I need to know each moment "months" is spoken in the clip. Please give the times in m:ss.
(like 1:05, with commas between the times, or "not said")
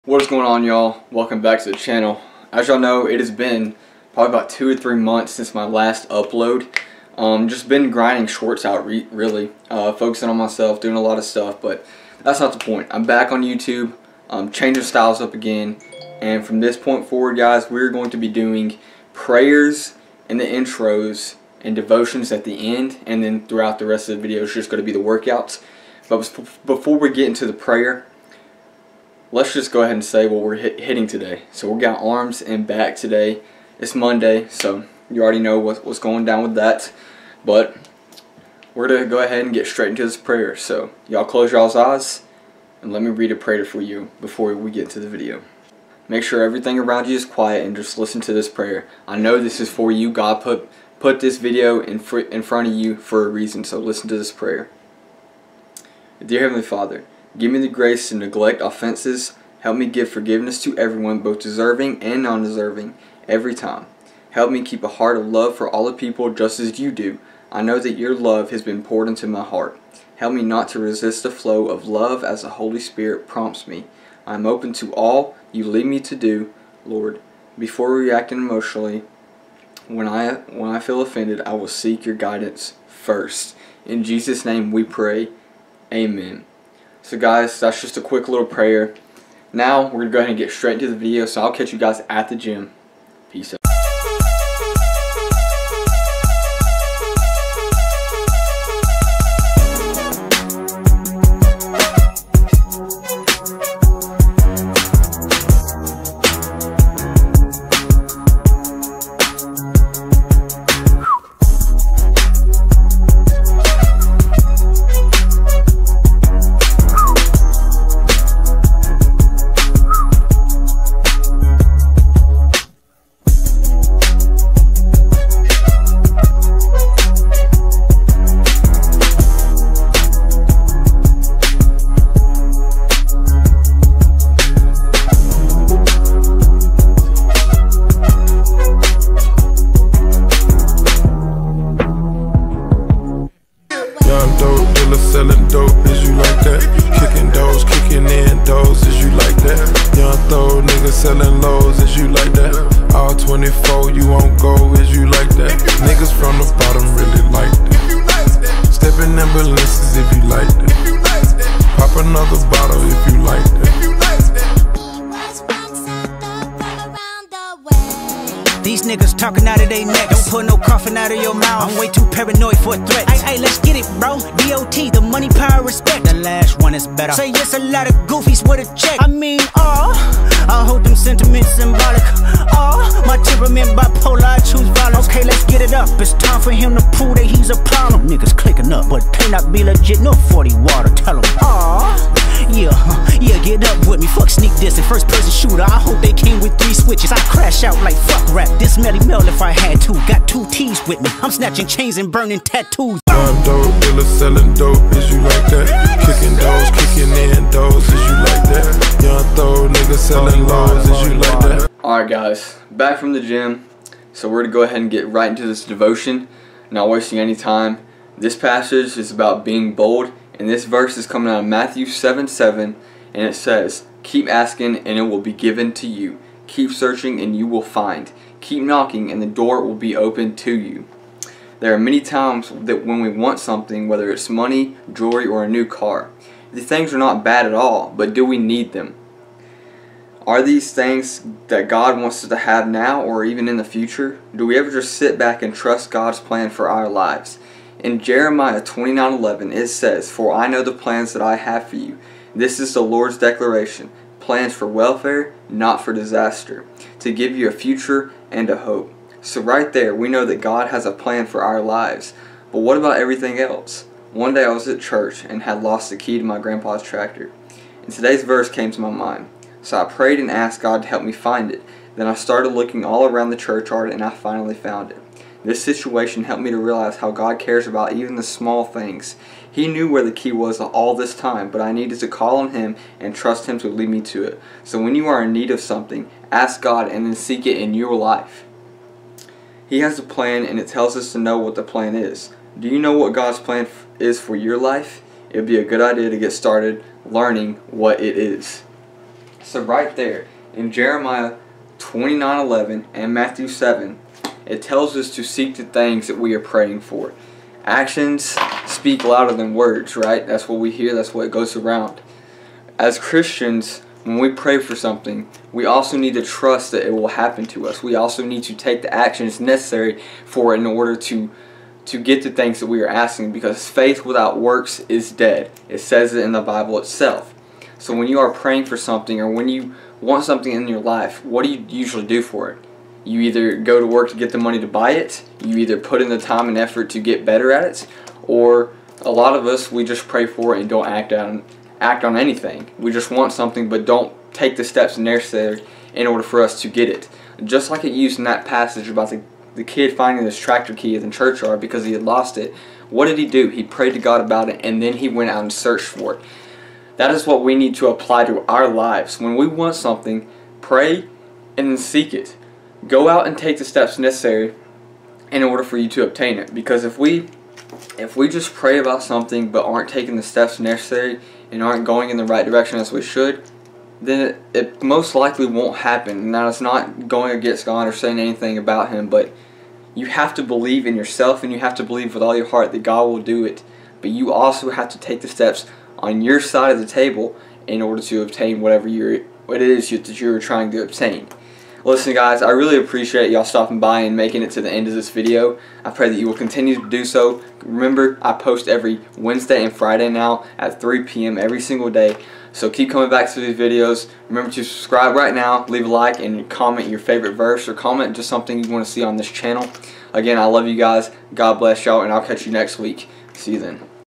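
0:04.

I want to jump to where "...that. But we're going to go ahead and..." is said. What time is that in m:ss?
0:36.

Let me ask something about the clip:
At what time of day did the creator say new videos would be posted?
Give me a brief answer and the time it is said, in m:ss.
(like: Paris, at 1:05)
3 p.m., at 6:40.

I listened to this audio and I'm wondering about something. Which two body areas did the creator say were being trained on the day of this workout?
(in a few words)
Arms and back.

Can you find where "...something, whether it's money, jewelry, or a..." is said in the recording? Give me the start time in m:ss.
3:53.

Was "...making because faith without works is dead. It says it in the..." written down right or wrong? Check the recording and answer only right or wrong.
wrong.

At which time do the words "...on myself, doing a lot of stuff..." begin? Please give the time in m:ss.
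0:10.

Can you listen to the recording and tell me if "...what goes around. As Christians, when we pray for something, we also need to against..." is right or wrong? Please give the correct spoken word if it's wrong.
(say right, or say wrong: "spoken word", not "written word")
wrong: "trust", not "against".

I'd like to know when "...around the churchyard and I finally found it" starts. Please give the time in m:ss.
4:33.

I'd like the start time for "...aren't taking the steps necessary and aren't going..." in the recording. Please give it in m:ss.
6:09.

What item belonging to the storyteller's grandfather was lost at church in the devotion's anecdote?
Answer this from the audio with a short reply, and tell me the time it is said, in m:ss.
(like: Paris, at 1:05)
Tractor key, at 4:25.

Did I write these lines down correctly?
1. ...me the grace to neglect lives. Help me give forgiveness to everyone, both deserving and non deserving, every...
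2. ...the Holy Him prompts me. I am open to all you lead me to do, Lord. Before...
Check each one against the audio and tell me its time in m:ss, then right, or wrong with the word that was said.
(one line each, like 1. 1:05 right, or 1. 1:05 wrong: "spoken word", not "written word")
1. 0:57 wrong: "offenses", not "lives"
2. 1:12 wrong: "Spirit", not "Him".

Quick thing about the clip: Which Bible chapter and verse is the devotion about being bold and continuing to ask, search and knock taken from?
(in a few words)
Matthew 7:7.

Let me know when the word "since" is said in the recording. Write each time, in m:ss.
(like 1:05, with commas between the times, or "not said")
0:05.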